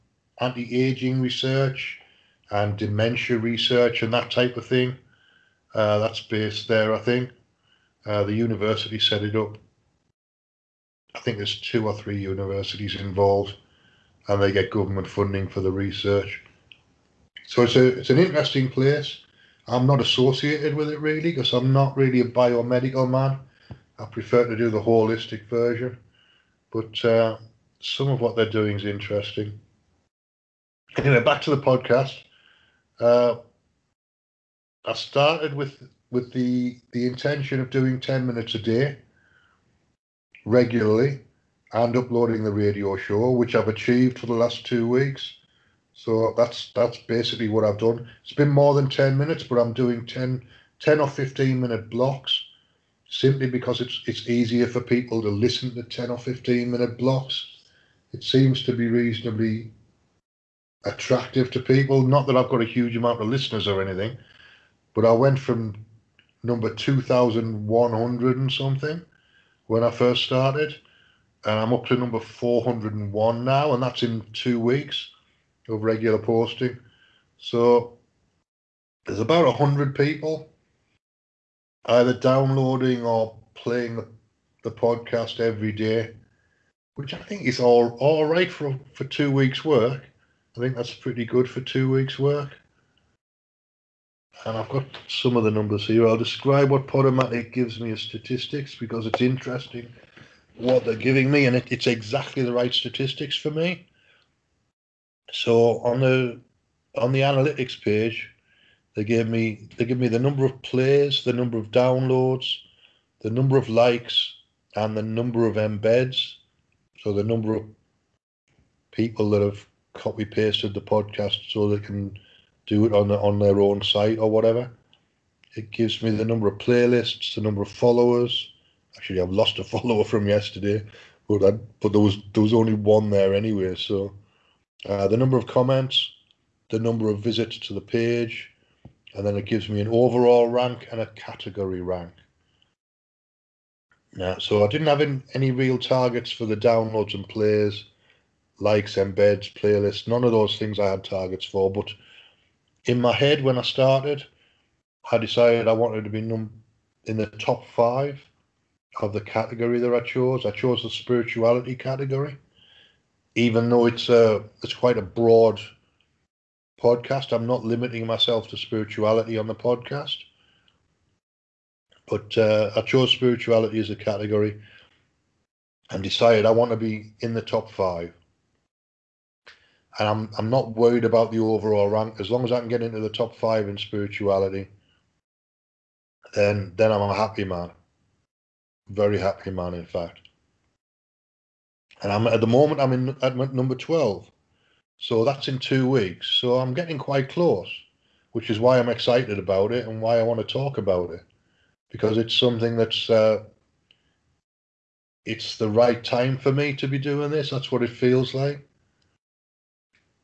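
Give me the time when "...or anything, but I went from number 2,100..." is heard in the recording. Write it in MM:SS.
01:03.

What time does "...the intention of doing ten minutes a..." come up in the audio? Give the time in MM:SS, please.
00:36.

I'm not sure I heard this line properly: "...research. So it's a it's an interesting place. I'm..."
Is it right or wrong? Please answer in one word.
right.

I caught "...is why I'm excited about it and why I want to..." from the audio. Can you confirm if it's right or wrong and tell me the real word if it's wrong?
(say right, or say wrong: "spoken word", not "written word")
right.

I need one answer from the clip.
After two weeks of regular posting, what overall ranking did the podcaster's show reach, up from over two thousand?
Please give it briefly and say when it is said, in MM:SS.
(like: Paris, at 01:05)
401, at 01:11.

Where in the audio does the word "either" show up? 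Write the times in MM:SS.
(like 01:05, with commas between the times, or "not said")
01:21.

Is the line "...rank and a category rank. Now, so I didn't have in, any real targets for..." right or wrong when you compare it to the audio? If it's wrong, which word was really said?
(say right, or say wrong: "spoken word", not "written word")
right.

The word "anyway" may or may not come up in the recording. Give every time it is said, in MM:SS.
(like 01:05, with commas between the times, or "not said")
00:30, 02:13.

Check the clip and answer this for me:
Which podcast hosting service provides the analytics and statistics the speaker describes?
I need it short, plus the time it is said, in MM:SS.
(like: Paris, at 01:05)
Podomatic, at 01:36.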